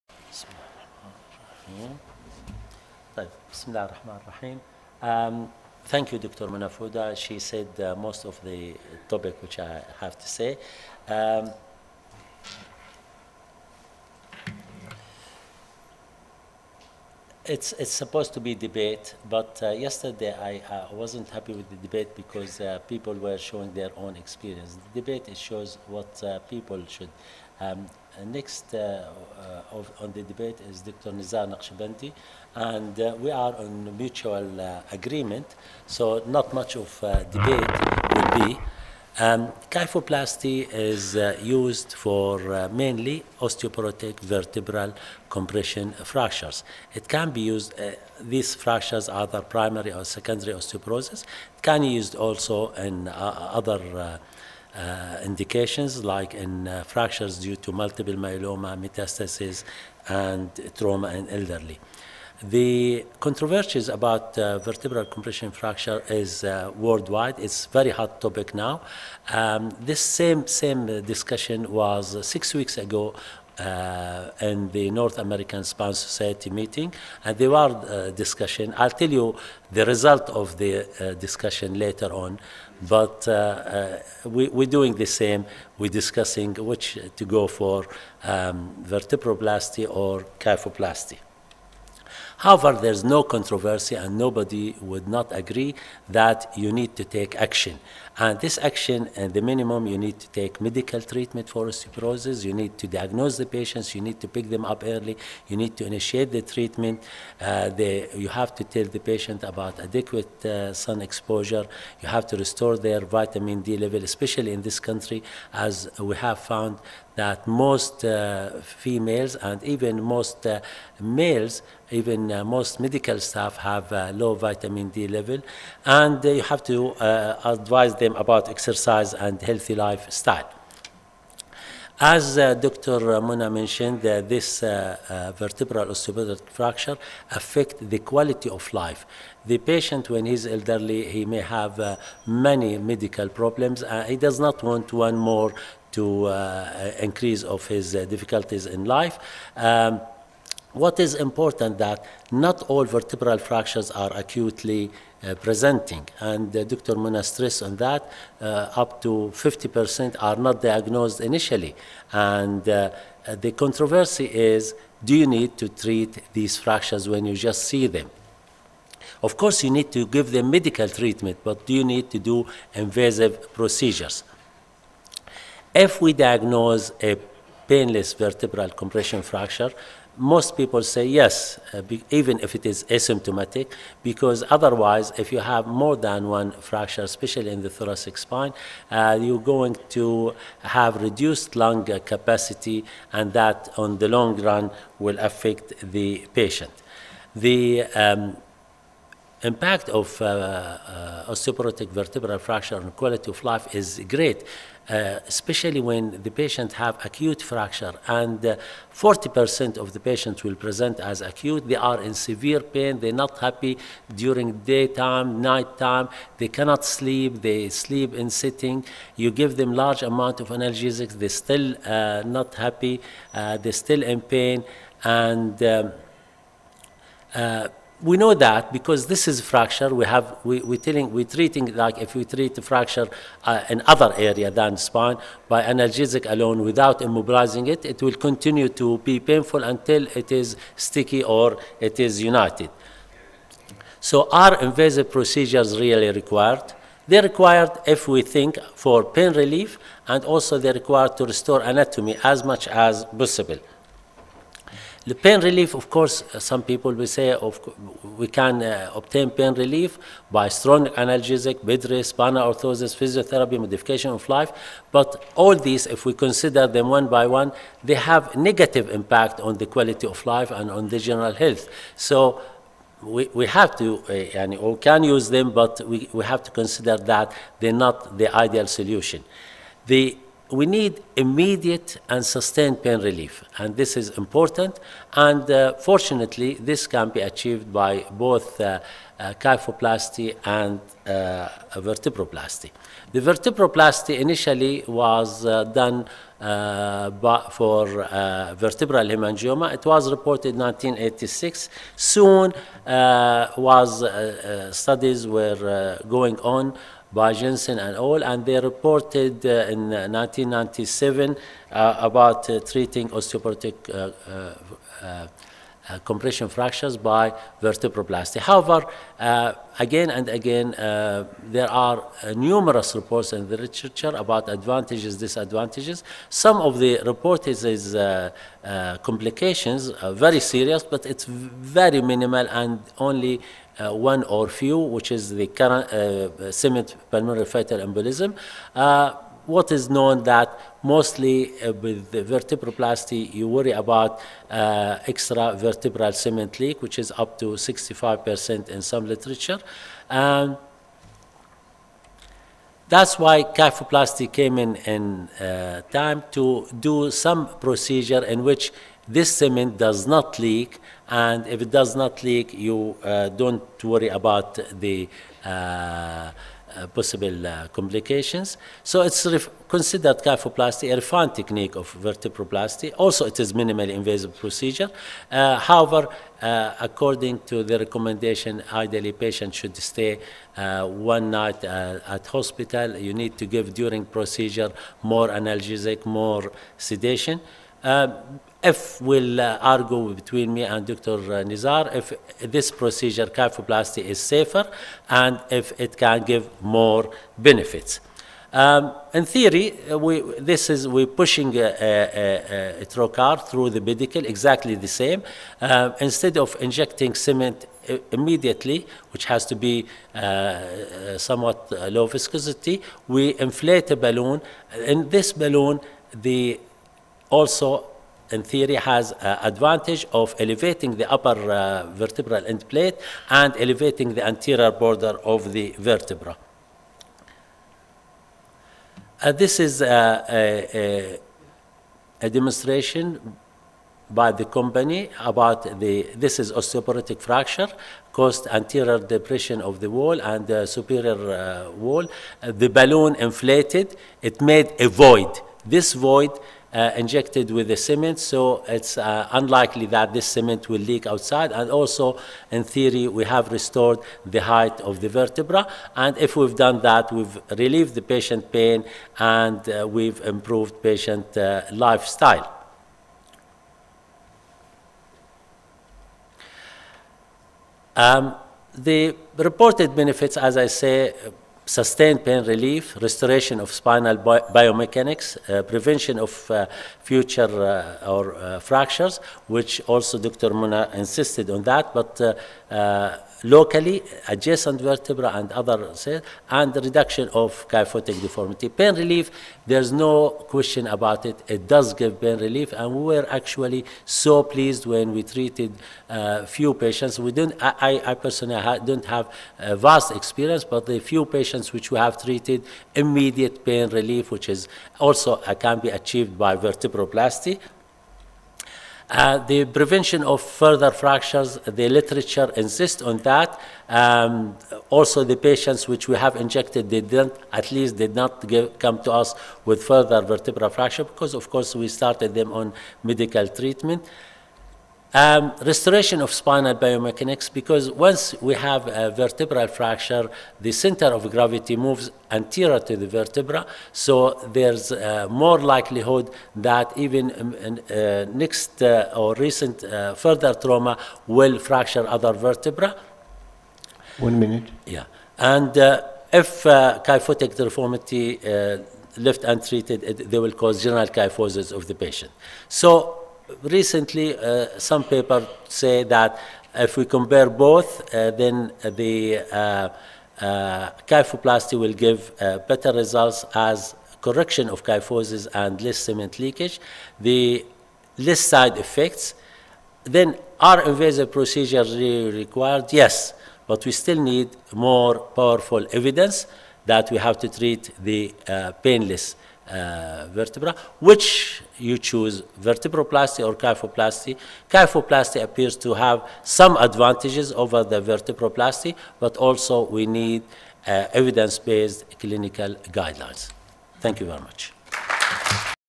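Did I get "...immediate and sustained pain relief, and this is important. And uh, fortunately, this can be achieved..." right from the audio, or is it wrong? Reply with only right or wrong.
right.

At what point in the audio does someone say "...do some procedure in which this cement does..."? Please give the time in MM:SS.
05:56.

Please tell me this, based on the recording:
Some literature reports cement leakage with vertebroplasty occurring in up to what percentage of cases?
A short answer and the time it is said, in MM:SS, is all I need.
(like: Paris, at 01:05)
65%, at 05:47.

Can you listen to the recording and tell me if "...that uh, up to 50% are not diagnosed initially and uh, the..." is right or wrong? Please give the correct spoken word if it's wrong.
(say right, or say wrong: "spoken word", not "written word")
right.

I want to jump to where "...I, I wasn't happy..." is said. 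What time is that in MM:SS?
00:20.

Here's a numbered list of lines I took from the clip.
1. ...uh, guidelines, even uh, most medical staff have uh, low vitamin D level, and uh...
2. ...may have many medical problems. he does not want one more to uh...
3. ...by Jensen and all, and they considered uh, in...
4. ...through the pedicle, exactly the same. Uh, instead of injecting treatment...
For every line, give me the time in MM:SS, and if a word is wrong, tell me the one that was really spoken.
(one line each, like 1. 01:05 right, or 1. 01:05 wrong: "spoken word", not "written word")
1. 02:00 wrong: "males", not "guidelines"
2. 02:21 right
3. 05:07 wrong: "reported", not "considered"
4. 06:43 wrong: "cement", not "treatment".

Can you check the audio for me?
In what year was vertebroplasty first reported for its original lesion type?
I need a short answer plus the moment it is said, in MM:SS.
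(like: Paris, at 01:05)
1986, at 05:00.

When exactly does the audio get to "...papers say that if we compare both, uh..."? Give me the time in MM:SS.
09:15.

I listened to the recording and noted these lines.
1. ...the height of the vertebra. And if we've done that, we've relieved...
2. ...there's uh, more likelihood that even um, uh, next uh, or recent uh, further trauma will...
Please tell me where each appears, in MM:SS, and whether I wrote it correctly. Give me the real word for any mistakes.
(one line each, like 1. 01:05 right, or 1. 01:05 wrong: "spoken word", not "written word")
1. 07:34 right
2. 08:54 right.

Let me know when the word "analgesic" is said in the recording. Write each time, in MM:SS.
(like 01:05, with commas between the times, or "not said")
03:40, 03:55, 04:20, 06:25.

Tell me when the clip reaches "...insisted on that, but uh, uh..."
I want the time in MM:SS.
08:00.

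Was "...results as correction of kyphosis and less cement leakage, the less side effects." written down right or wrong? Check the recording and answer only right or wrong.
right.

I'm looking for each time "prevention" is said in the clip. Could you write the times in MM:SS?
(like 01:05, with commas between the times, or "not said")
07:55, 08:29.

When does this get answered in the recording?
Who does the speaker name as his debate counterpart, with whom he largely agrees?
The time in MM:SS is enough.
00:30.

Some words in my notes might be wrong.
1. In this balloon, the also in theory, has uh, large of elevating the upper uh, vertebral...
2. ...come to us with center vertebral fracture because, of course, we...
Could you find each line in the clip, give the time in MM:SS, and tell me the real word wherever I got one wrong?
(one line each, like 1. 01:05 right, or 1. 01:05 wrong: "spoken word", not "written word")
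1. 06:54 wrong: "advantage", not "large"
2. 08:38 wrong: "further", not "center".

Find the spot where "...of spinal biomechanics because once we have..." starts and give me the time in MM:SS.
08:46.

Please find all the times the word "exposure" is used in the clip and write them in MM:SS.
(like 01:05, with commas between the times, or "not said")
01:51.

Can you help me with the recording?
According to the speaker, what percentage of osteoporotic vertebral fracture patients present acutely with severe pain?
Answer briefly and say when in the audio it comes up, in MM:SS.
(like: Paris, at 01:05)
40%, at 03:28.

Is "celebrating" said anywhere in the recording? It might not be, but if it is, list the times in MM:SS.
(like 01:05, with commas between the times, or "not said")
not said.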